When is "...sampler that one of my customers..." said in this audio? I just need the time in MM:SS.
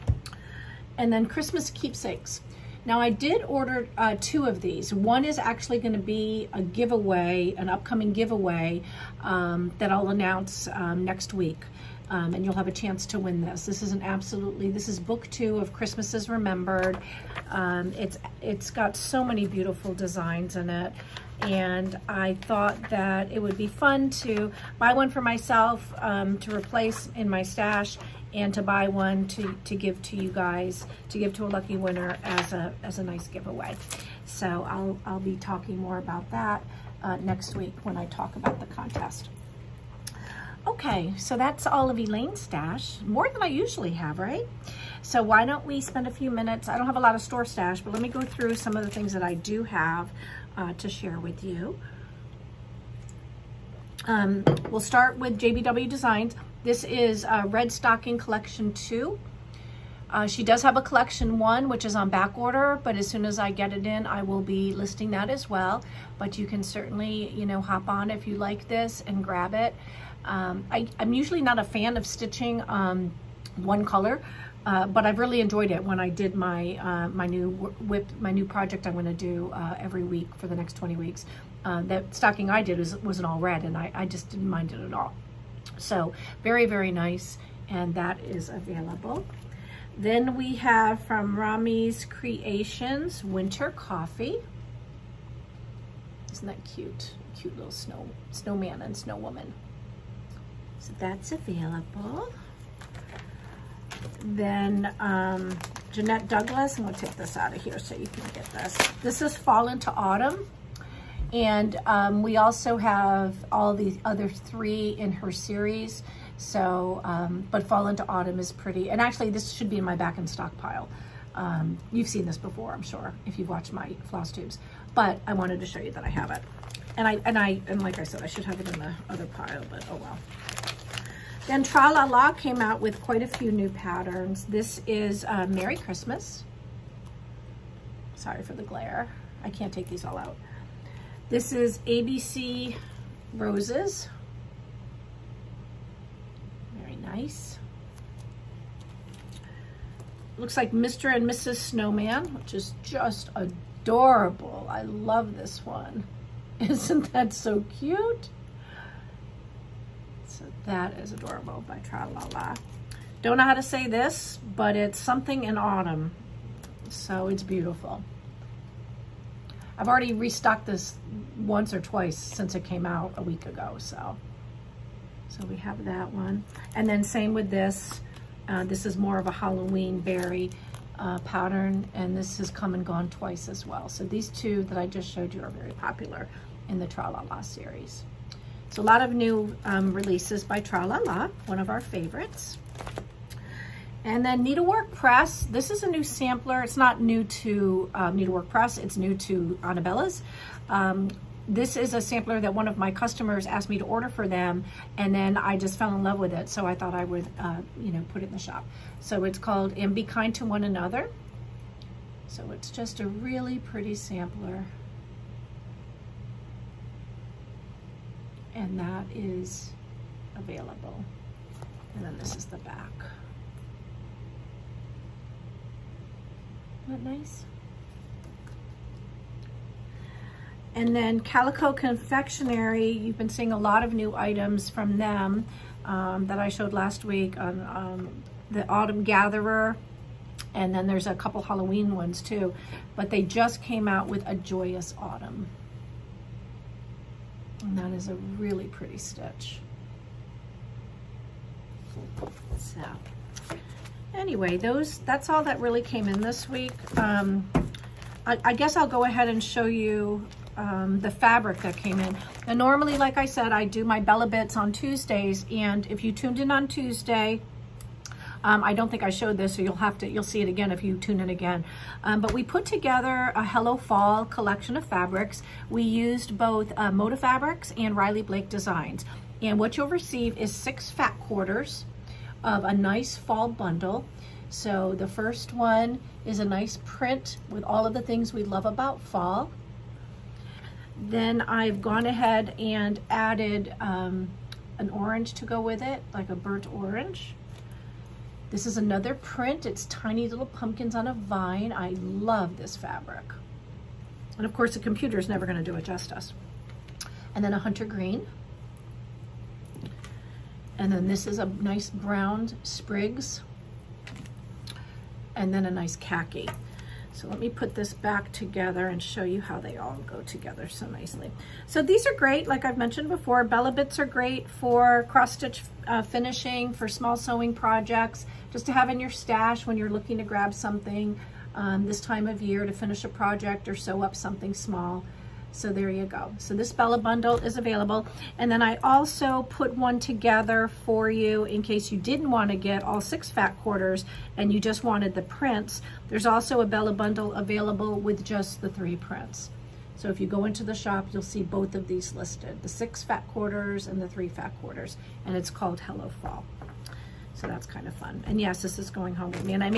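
03:22.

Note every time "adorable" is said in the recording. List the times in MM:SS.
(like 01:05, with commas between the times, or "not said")
02:33, 02:41.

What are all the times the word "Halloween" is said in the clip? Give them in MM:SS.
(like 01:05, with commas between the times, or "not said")
02:59, 04:01.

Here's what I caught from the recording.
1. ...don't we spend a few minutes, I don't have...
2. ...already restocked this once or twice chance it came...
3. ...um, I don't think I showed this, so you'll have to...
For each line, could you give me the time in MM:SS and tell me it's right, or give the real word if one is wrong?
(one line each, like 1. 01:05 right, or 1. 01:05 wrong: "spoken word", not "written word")
1. 00:45 right
2. 02:49 wrong: "since", not "chance"
3. 04:28 right.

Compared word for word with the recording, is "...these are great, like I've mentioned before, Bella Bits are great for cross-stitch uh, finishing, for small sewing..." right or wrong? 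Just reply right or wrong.
right.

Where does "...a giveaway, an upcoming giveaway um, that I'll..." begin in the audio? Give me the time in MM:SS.
00:06.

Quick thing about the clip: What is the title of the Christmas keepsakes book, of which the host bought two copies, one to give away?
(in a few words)
Christmas is Remembered.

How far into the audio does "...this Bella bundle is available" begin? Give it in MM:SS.
05:36.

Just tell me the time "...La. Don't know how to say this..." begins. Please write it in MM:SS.
02:42.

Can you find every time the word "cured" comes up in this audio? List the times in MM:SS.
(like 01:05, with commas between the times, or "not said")
not said.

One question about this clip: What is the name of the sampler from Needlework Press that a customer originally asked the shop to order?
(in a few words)
And Be Kind to One Another.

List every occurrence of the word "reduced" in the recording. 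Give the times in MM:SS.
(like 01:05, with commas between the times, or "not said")
not said.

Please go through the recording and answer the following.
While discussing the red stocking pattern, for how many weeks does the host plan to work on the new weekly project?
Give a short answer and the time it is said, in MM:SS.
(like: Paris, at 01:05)
20, at 01:20.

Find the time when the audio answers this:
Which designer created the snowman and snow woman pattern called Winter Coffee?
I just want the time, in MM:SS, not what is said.
01:31.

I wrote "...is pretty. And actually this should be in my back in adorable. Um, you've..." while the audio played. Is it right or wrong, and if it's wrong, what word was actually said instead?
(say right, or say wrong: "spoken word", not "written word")
wrong: "stockpile", not "adorable".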